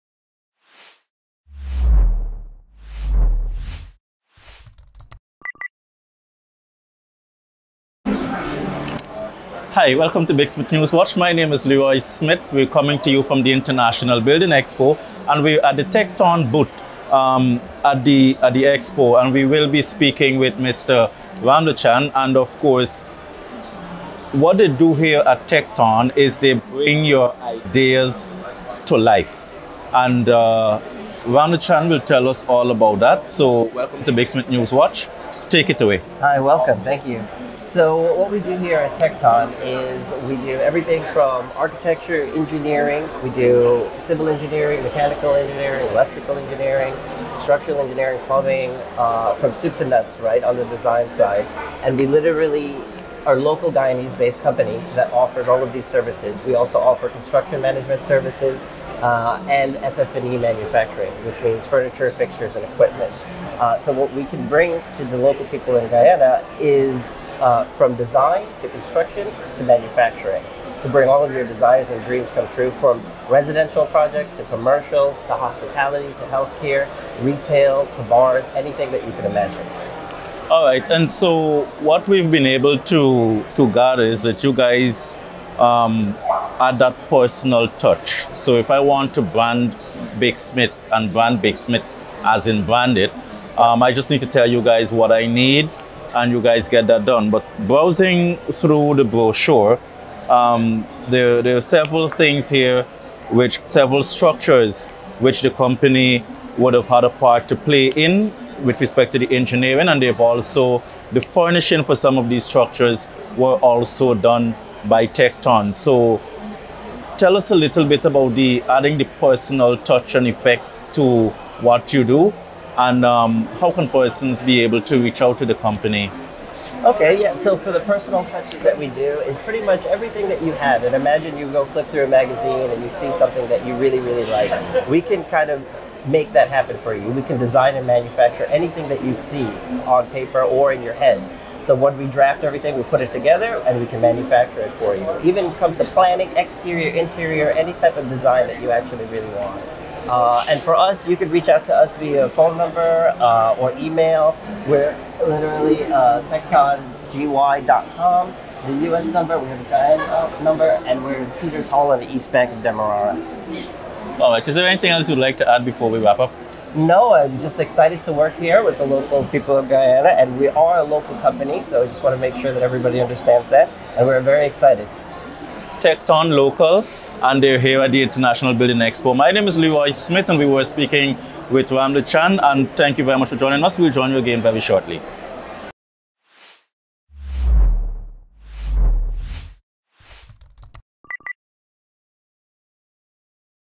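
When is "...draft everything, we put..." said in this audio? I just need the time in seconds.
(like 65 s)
142 s.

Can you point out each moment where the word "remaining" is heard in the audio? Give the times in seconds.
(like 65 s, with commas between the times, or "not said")
not said.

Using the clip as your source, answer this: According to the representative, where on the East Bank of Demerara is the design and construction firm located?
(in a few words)
Peters Hall.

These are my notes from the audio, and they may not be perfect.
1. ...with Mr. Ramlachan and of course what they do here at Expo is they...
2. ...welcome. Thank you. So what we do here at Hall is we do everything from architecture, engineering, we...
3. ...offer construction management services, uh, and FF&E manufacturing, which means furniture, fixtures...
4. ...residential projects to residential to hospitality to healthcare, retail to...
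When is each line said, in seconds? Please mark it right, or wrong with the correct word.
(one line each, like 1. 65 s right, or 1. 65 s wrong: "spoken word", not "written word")
1. 20 s wrong: "Tekton", not "Expo"
2. 36 s wrong: "Tekton", not "Hall"
3. 56 s right
4. 73 s wrong: "commercial", not "residential".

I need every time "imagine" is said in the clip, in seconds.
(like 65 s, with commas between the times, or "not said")
79 s, 130 s.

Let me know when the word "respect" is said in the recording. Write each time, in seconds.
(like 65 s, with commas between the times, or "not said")
108 s.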